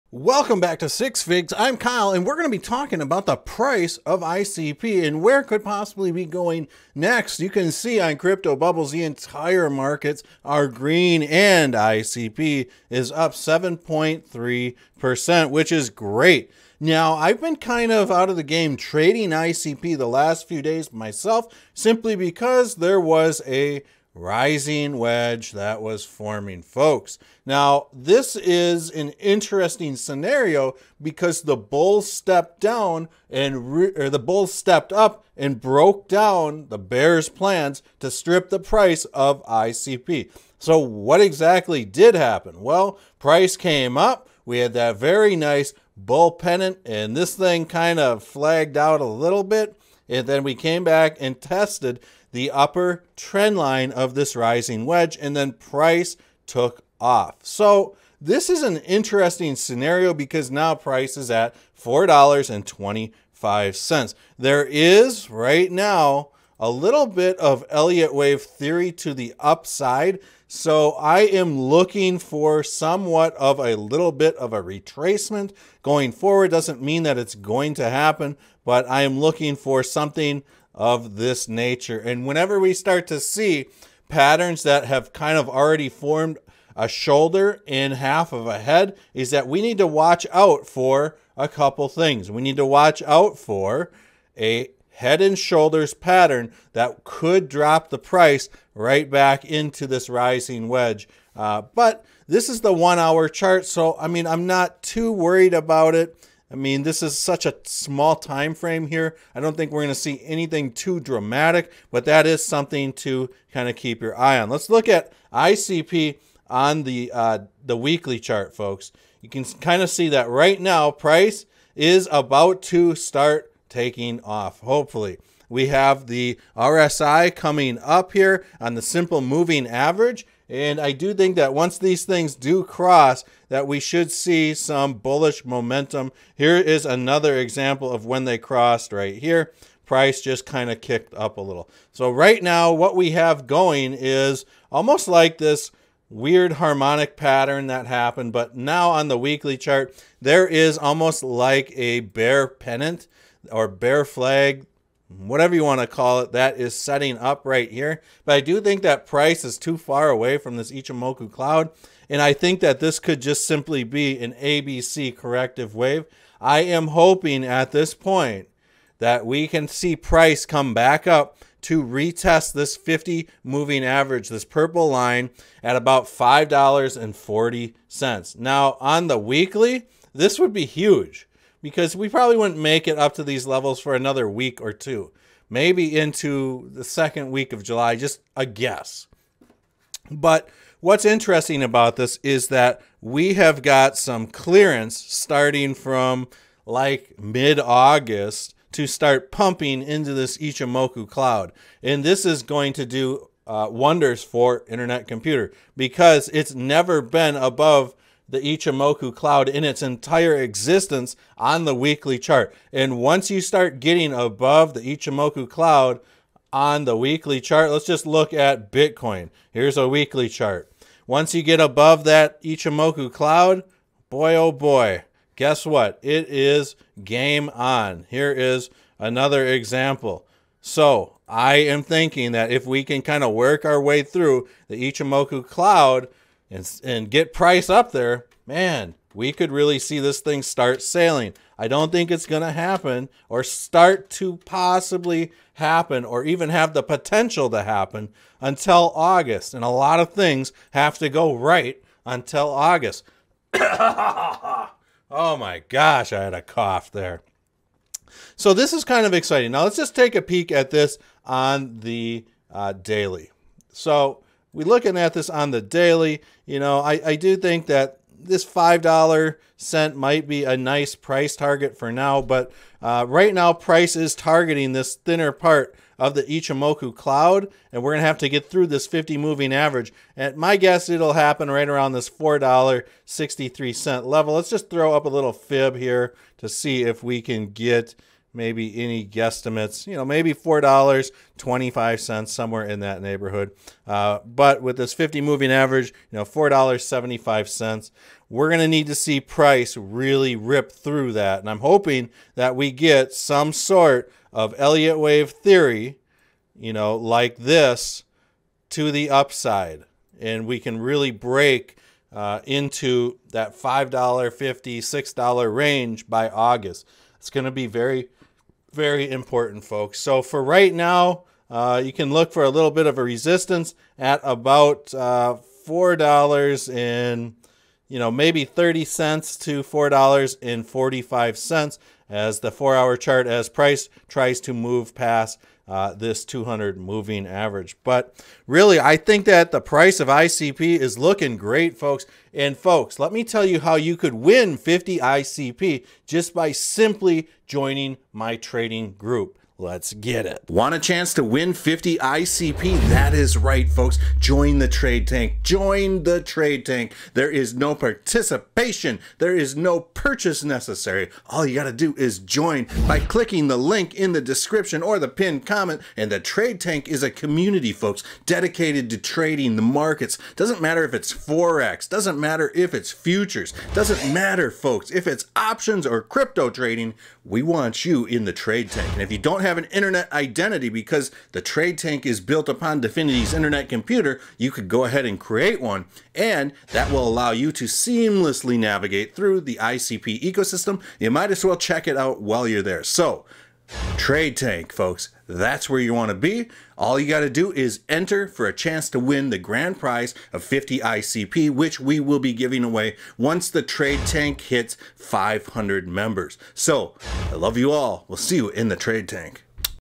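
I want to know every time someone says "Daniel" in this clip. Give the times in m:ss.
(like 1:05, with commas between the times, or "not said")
not said.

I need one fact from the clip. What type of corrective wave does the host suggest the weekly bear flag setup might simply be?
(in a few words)
ABC corrective wave.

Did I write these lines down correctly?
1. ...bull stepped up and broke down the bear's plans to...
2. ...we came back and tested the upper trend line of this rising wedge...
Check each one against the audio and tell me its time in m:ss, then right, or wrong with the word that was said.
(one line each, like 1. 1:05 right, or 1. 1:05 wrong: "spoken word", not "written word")
1. 0:34 right
2. 0:50 right.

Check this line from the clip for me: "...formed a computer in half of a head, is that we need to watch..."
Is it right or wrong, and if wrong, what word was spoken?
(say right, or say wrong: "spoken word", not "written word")
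wrong: "shoulder", not "computer".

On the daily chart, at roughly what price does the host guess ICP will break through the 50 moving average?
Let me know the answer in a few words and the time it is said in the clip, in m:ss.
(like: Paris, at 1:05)
$4.63, at 4:42.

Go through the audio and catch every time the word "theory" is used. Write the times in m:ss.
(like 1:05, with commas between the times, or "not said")
1:08, 5:05.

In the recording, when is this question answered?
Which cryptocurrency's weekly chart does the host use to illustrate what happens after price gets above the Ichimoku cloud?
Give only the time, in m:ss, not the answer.
3:38.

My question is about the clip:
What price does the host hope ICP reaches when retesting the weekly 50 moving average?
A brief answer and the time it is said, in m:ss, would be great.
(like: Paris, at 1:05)
$5.40, at 2:56.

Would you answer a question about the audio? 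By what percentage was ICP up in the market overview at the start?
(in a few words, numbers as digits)
7.3%.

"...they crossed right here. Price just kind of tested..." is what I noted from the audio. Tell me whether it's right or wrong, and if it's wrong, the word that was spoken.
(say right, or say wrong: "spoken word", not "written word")
wrong: "kicked", not "tested".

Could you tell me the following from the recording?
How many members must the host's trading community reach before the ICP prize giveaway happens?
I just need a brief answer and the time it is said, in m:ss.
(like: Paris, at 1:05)
500, at 6:44.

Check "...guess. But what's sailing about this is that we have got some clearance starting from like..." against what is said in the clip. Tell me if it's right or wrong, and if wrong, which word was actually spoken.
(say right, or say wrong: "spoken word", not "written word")
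wrong: "interesting", not "sailing".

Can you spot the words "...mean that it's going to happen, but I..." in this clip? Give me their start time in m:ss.
1:16.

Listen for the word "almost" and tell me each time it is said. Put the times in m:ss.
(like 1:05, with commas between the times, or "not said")
2:24, 2:30.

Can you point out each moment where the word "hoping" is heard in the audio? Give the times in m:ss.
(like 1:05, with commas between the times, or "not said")
2:46, 5:01.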